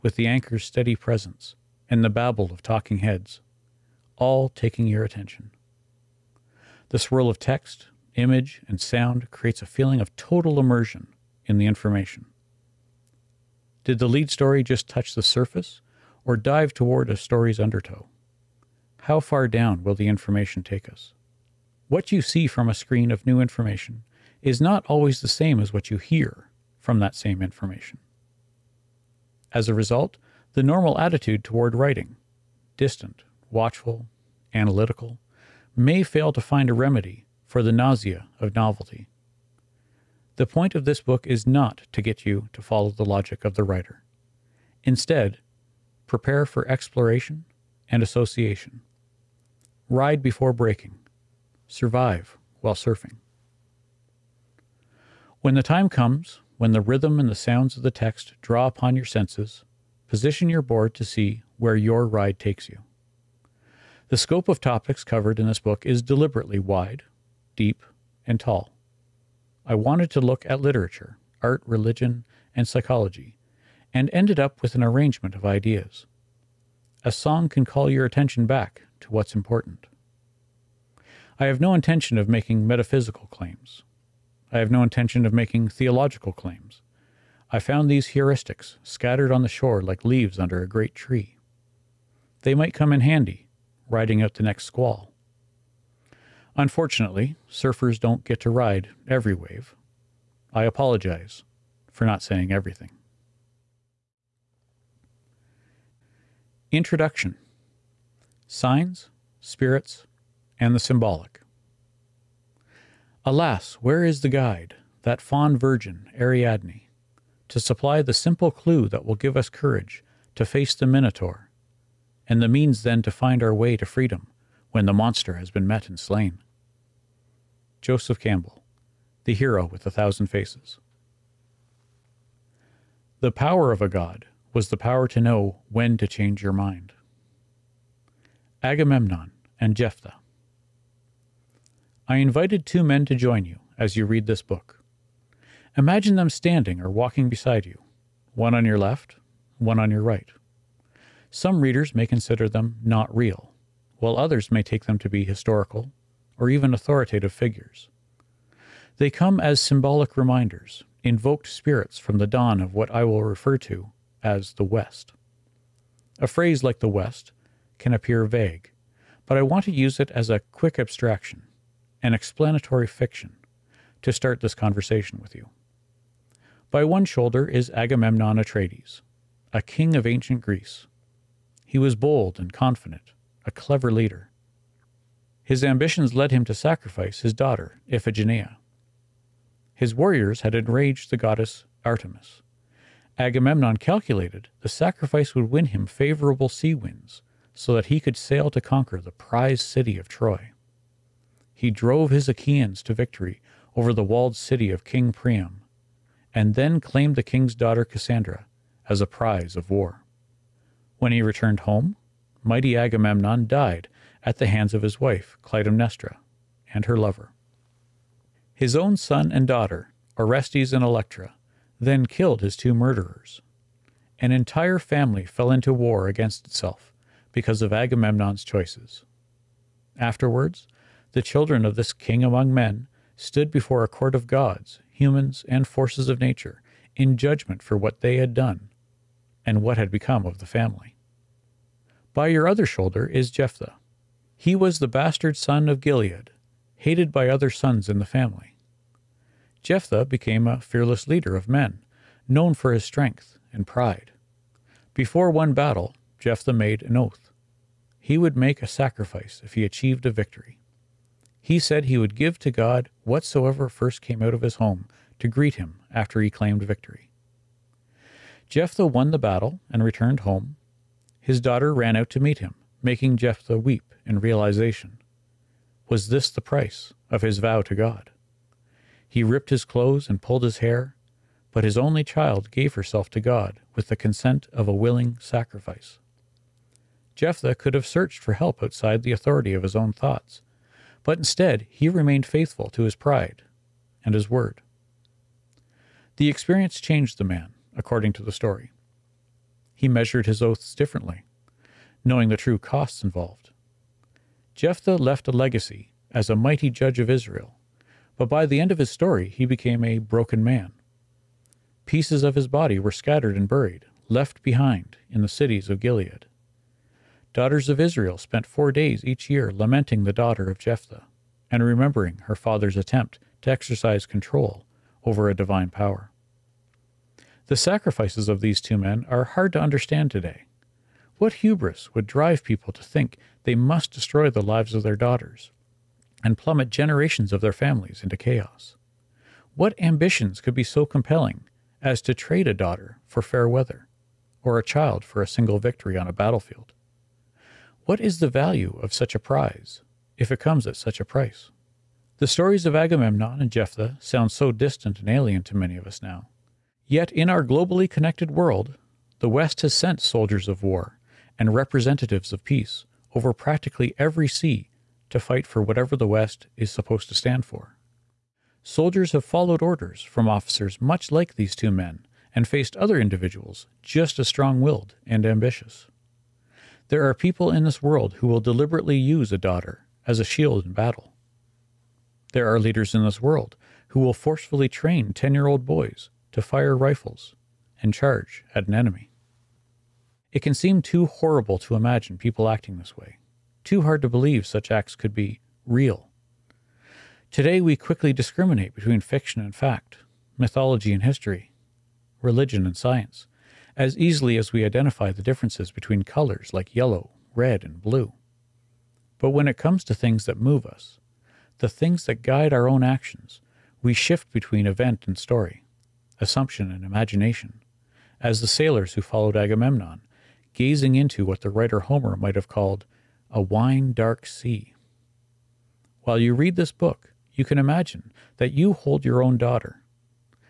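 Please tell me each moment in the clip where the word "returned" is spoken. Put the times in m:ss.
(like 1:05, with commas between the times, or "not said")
3:31, 4:29.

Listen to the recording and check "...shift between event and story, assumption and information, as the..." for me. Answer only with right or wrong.
wrong.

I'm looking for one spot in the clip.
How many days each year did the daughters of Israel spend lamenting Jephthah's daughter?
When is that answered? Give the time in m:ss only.
5:18.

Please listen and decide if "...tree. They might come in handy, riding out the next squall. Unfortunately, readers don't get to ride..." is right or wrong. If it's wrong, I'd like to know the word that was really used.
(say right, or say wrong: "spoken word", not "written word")
wrong: "surfers", not "readers".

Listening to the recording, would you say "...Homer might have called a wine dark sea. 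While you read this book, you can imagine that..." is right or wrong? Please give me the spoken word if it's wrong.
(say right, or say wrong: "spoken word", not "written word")
right.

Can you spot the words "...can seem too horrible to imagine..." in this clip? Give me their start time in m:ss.
6:30.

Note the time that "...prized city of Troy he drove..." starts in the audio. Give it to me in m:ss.
3:19.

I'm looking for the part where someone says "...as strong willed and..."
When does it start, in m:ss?
6:14.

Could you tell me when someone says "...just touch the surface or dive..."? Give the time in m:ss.
0:14.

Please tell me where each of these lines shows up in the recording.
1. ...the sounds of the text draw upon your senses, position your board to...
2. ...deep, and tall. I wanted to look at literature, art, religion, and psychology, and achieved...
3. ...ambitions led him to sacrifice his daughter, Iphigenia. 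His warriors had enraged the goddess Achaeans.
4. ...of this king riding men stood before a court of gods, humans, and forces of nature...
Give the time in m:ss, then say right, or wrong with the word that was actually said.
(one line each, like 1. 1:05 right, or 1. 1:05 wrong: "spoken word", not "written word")
1. 0:57 right
2. 1:07 wrong: "ended", not "achieved"
3. 3:05 wrong: "Artemis", not "Achaeans"
4. 3:51 wrong: "among", not "riding".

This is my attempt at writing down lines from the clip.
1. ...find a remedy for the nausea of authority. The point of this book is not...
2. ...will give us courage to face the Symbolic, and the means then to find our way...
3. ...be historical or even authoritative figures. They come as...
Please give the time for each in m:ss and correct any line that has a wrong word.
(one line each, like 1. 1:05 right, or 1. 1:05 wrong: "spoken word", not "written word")
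1. 0:36 wrong: "novelty", not "authority"
2. 1:59 wrong: "Minotaur", not "Symbolic"
3. 2:35 right.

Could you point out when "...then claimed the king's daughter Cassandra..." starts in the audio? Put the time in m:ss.
3:26.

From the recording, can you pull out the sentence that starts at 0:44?
Instead, prepare for exploration and association.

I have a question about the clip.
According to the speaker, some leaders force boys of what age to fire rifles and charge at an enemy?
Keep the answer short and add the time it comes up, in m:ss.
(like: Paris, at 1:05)
10, at 6:25.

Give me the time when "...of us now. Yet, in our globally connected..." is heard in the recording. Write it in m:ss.
5:55.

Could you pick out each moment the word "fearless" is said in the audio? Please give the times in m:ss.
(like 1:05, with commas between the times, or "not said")
4:10.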